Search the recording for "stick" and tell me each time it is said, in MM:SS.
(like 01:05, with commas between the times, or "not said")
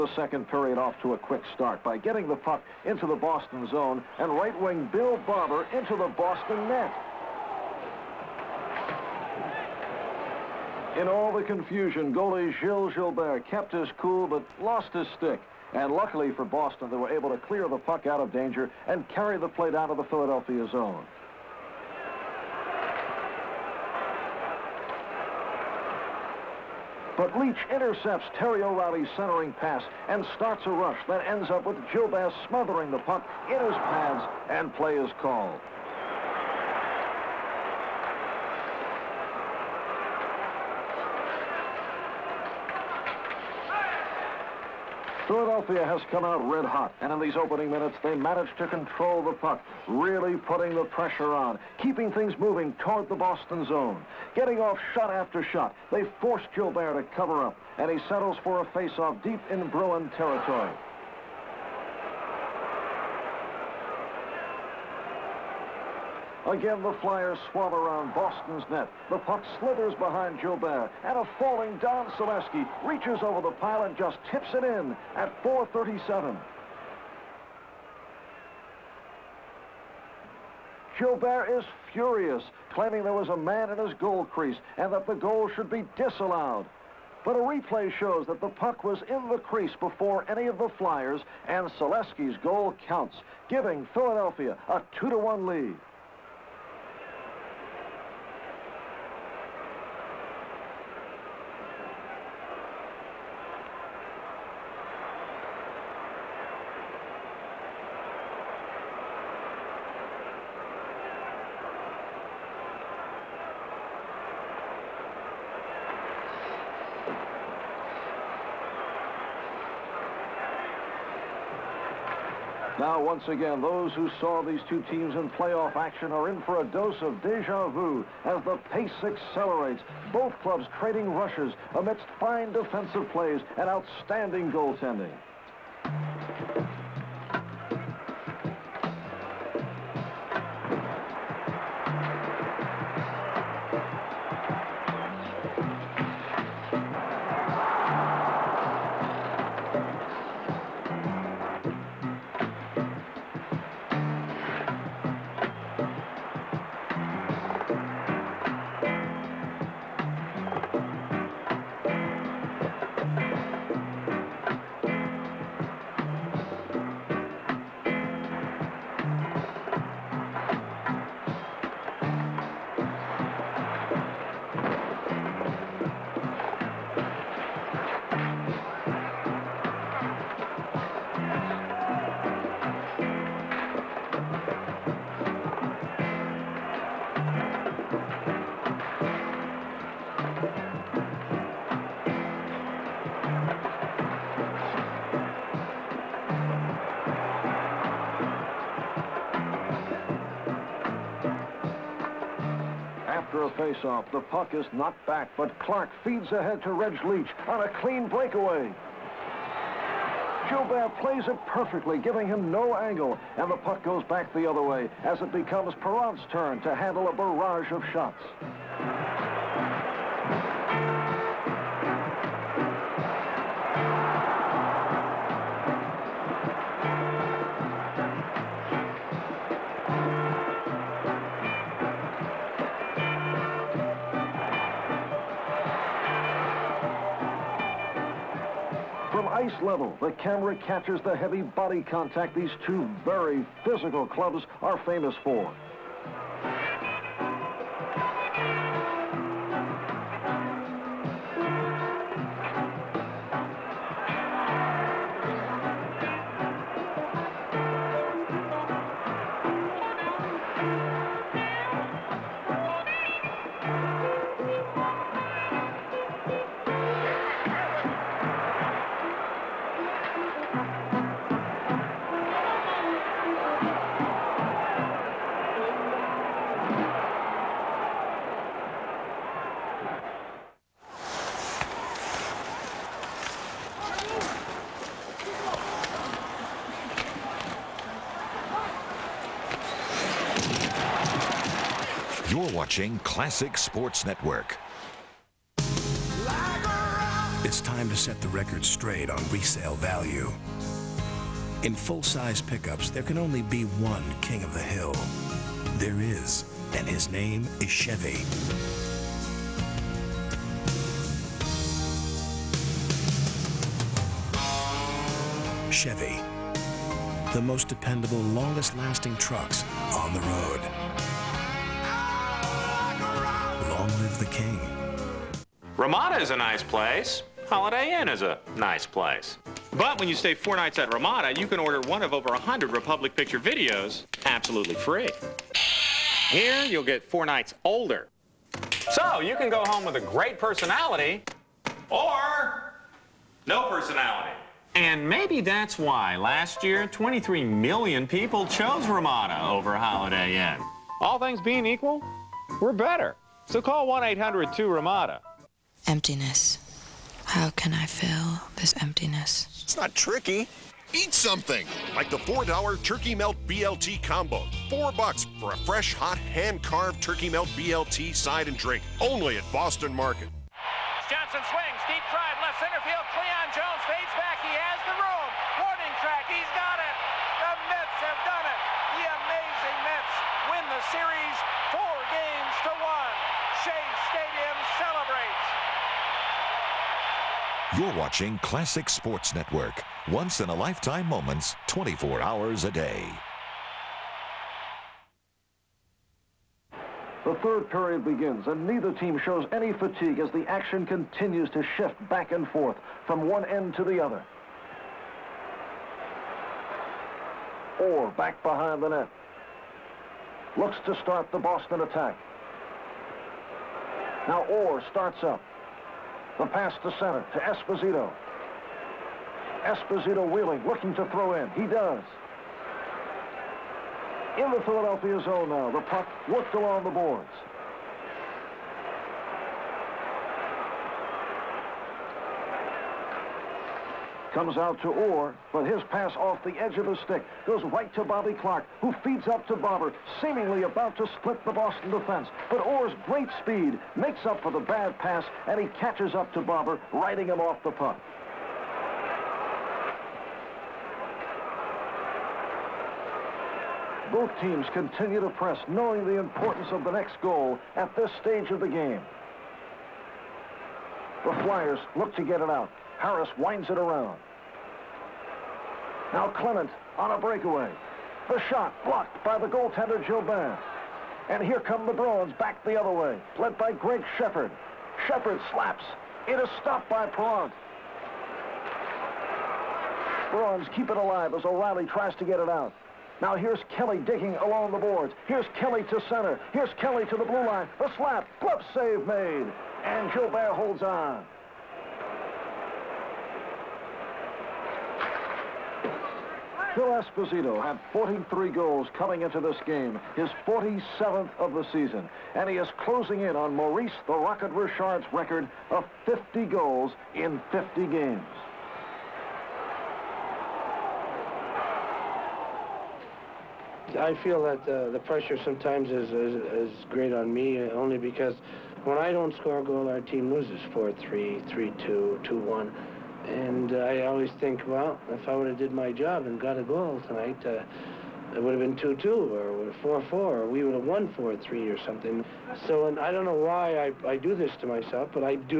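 00:15, 07:16.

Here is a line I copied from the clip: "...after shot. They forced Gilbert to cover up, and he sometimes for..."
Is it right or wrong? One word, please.
wrong.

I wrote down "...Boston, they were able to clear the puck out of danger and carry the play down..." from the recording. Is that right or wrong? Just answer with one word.
right.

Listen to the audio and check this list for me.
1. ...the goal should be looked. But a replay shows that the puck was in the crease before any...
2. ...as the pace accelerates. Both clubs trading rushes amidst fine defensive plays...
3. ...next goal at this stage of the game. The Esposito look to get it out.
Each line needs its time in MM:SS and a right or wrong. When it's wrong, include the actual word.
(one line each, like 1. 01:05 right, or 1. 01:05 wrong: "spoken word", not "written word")
1. 01:25 wrong: "disallowed", not "looked"
2. 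02:08 right
3. 07:36 wrong: "Flyers", not "Esposito".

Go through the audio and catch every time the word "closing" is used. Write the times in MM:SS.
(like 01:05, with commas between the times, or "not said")
08:22.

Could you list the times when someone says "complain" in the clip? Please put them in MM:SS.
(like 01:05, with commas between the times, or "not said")
not said.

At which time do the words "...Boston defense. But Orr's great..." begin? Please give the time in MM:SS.
07:21.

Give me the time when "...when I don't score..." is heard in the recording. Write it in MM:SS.
08:38.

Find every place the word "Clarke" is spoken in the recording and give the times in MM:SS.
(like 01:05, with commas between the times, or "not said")
03:25, 07:18.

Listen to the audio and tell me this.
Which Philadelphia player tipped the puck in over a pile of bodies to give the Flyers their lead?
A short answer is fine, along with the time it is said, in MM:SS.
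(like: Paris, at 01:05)
Don Saleski, at 01:11.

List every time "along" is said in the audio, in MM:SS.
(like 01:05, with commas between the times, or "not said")
07:06, 08:04.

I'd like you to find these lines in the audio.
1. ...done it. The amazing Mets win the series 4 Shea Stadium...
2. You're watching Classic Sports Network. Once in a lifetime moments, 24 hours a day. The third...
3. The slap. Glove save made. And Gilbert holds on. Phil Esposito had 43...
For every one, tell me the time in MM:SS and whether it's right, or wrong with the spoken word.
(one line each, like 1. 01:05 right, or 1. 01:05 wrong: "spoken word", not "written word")
1. 06:18 right
2. 06:27 right
3. 08:07 right.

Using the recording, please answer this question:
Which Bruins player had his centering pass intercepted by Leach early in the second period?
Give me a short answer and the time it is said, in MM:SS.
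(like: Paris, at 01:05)
Terry O'Reilly, at 00:28.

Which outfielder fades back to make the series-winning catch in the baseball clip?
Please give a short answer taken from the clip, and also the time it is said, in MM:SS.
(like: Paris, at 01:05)
Cleon Jones, at 06:13.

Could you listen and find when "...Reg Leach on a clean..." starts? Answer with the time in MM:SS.
03:26.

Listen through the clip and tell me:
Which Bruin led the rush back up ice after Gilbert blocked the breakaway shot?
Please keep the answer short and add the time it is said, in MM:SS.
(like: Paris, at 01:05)
Gregg Sheppard, at 07:53.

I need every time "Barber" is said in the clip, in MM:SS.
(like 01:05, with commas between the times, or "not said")
00:05, 07:19, 07:26.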